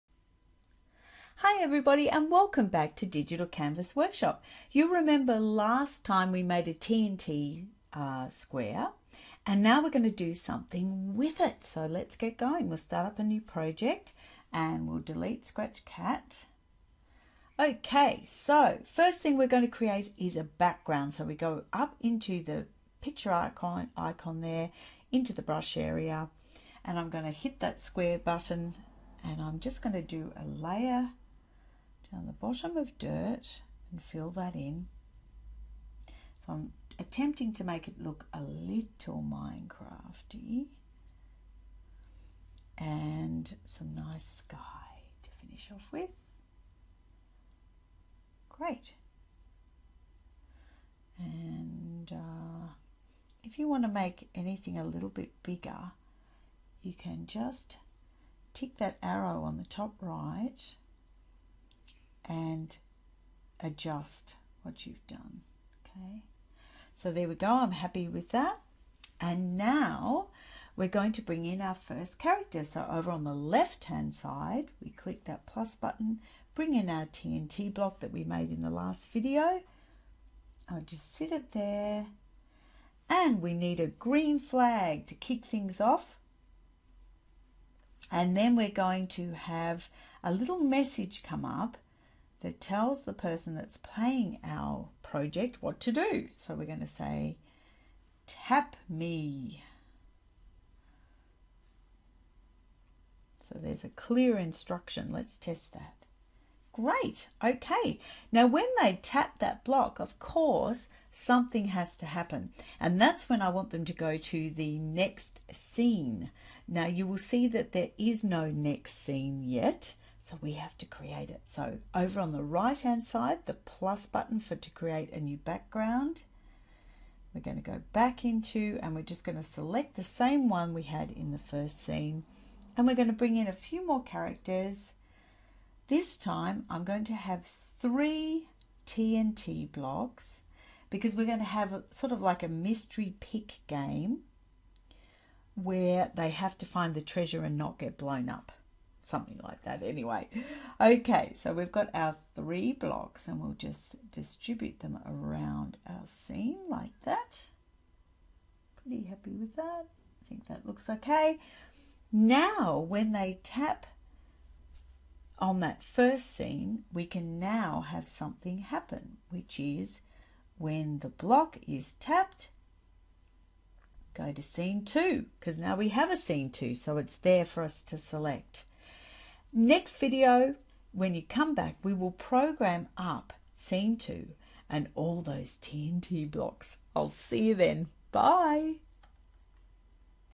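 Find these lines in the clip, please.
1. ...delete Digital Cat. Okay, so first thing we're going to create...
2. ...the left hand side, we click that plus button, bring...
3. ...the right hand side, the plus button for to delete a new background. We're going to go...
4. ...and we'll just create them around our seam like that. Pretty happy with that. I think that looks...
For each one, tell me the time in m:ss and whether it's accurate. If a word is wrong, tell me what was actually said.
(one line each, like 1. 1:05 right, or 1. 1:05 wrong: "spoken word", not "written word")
1. 0:15 wrong: "Scratch", not "Digital"
2. 1:13 right
3. 2:02 wrong: "create", not "delete"
4. 2:33 wrong: "distribute", not "create".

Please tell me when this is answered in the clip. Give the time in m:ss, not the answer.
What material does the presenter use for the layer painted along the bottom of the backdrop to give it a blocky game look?
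0:32.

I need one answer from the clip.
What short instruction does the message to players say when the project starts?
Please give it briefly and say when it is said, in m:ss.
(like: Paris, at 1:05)
Tap me, at 1:38.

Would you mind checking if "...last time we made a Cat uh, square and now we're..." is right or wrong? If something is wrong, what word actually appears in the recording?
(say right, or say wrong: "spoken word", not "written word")
wrong: "TNT", not "Cat".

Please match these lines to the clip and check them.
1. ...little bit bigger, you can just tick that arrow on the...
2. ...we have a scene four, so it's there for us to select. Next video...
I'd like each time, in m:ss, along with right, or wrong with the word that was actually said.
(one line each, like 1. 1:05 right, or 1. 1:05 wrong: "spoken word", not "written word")
1. 0:54 right
2. 2:55 wrong: "two", not "four".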